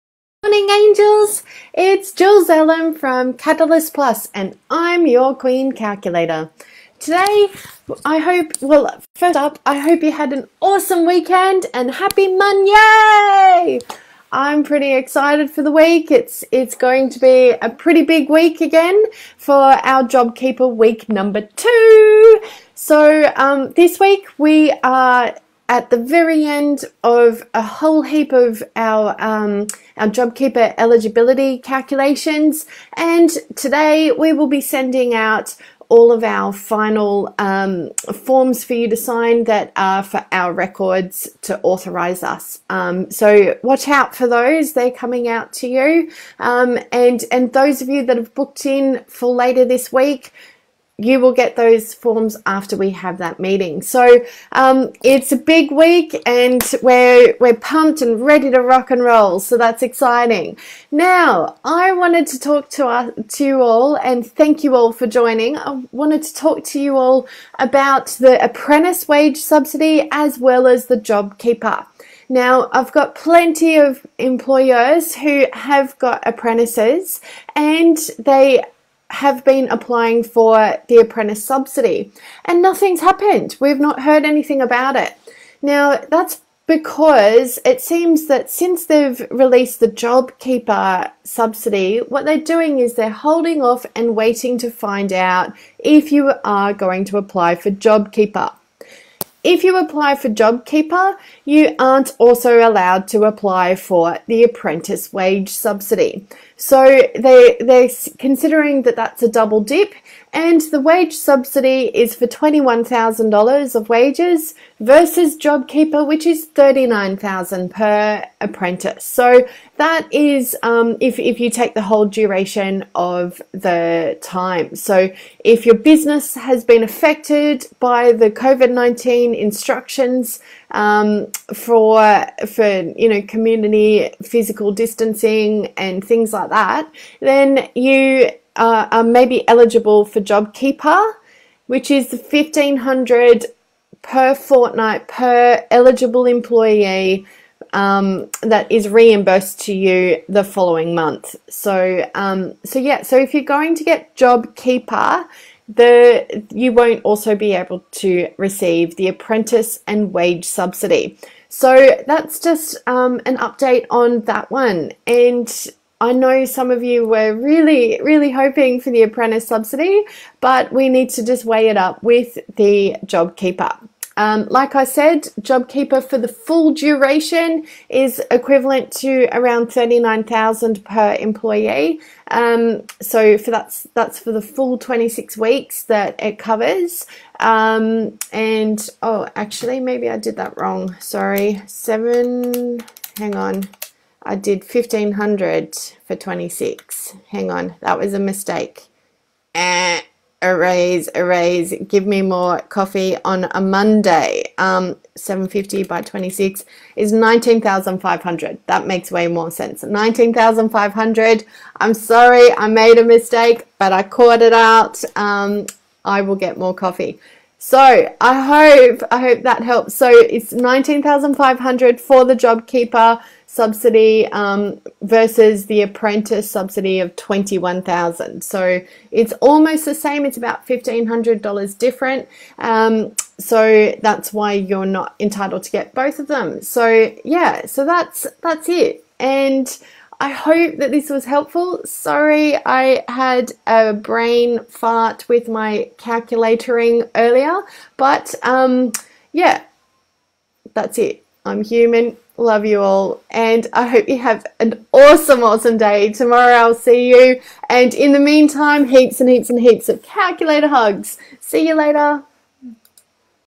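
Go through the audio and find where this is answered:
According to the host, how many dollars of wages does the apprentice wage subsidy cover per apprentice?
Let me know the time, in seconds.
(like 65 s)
112 s.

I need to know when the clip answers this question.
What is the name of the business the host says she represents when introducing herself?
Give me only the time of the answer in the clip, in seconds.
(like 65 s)
3 s.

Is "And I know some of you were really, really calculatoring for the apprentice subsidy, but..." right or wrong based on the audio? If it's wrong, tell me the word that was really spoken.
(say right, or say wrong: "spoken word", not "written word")
wrong: "hoping", not "calculatoring".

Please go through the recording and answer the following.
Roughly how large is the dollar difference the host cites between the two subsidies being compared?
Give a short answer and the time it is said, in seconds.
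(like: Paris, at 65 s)
$1,500, at 230 s.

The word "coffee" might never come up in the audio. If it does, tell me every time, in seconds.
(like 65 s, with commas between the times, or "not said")
202 s, 216 s.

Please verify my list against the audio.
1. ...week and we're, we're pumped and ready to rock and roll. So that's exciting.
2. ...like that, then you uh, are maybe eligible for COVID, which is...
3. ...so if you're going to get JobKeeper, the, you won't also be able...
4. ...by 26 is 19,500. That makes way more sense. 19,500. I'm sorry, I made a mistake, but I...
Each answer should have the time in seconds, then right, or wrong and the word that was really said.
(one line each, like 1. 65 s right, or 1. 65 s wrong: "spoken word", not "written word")
1. 55 s right
2. 136 s wrong: "JobKeeper", not "COVID"
3. 153 s right
4. 205 s right.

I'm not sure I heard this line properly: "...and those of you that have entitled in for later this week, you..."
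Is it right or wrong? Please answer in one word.
wrong.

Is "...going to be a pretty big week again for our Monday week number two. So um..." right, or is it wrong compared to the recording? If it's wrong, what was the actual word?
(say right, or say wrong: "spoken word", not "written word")
wrong: "JobKeeper", not "Monday".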